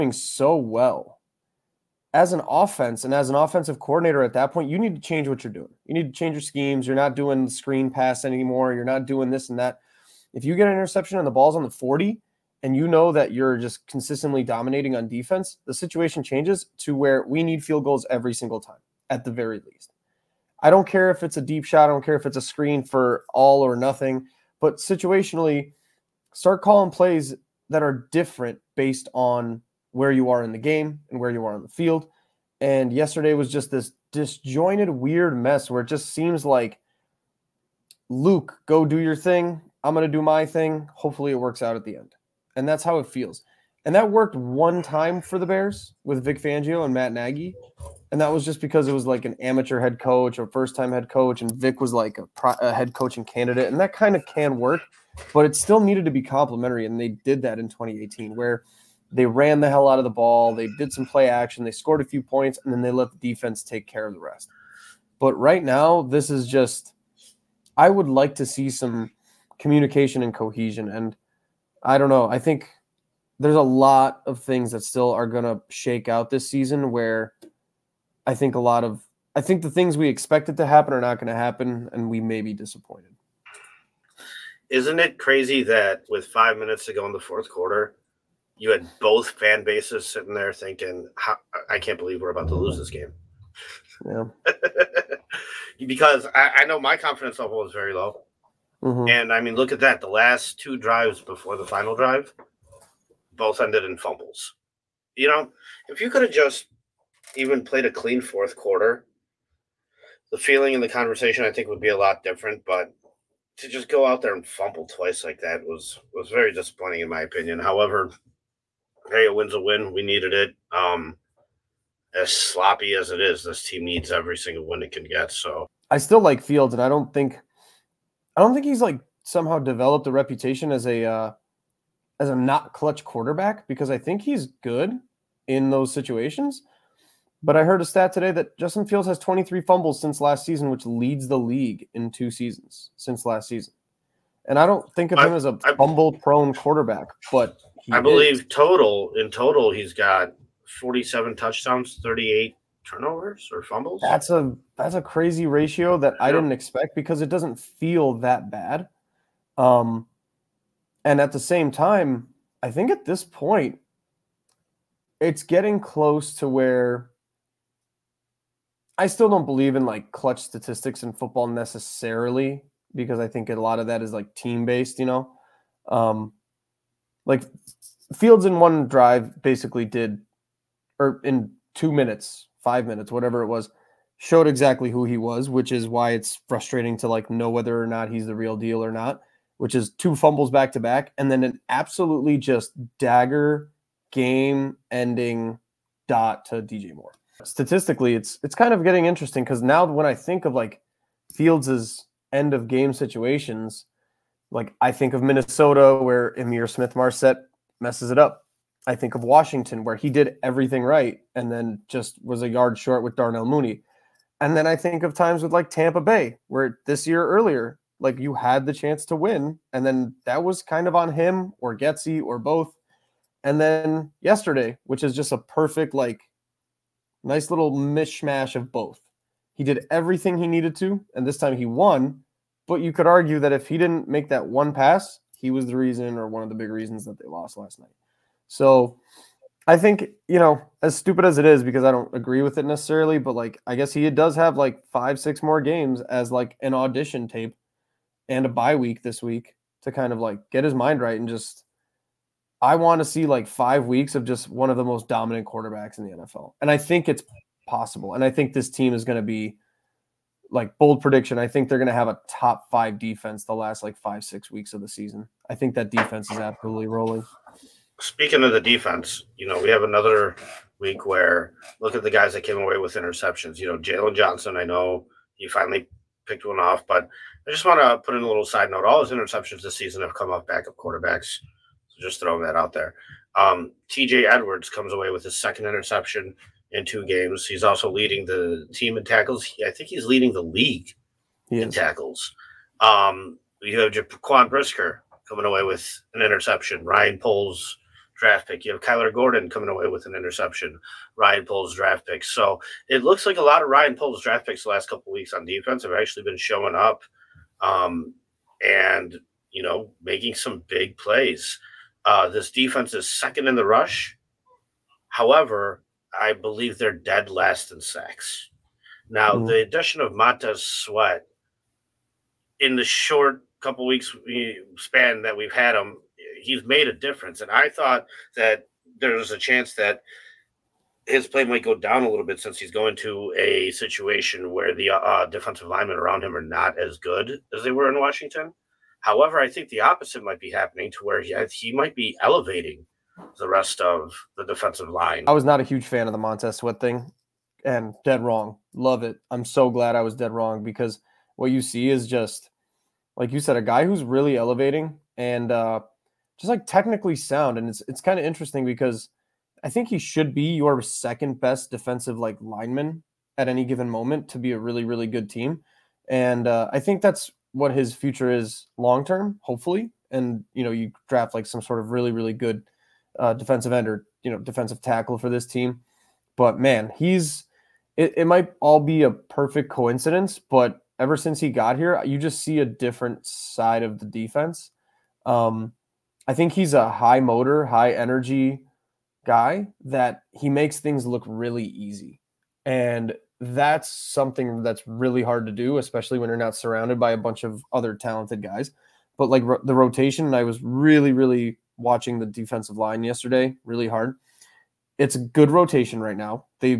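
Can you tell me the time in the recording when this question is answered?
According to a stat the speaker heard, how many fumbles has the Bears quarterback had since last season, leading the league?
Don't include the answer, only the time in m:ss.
2:19.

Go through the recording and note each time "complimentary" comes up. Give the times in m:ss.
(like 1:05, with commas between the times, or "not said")
0:56.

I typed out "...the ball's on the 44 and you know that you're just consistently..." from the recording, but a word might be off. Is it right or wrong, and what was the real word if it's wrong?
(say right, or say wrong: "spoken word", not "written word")
wrong: "40", not "44".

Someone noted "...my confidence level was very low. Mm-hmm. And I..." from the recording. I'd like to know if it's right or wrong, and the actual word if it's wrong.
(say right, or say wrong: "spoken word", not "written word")
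right.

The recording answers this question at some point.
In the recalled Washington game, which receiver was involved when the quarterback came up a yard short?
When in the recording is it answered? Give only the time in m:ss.
3:33.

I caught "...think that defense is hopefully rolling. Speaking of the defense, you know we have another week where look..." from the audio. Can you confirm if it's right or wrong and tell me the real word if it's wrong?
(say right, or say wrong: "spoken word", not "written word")
wrong: "absolutely", not "hopefully".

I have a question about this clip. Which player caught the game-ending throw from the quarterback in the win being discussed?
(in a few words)
DJ Moore.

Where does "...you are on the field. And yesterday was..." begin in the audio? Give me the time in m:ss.
0:31.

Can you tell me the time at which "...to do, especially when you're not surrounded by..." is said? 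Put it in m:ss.
6:35.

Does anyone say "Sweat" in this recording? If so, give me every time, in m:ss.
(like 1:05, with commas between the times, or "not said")
5:20, 5:46.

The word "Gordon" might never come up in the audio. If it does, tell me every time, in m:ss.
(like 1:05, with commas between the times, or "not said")
4:59.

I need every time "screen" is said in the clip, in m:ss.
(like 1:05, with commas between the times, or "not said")
0:07, 0:22.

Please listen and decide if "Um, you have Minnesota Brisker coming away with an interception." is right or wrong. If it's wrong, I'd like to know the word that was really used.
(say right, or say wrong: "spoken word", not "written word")
wrong: "Jaquan", not "Minnesota".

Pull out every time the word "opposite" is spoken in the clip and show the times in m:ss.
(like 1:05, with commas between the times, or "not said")
5:39.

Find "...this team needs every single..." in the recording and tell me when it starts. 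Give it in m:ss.
2:03.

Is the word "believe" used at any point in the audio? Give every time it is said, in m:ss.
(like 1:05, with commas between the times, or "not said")
1:31, 2:28, 2:49, 5:16.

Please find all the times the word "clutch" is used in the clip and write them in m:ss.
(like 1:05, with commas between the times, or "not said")
2:12, 2:50.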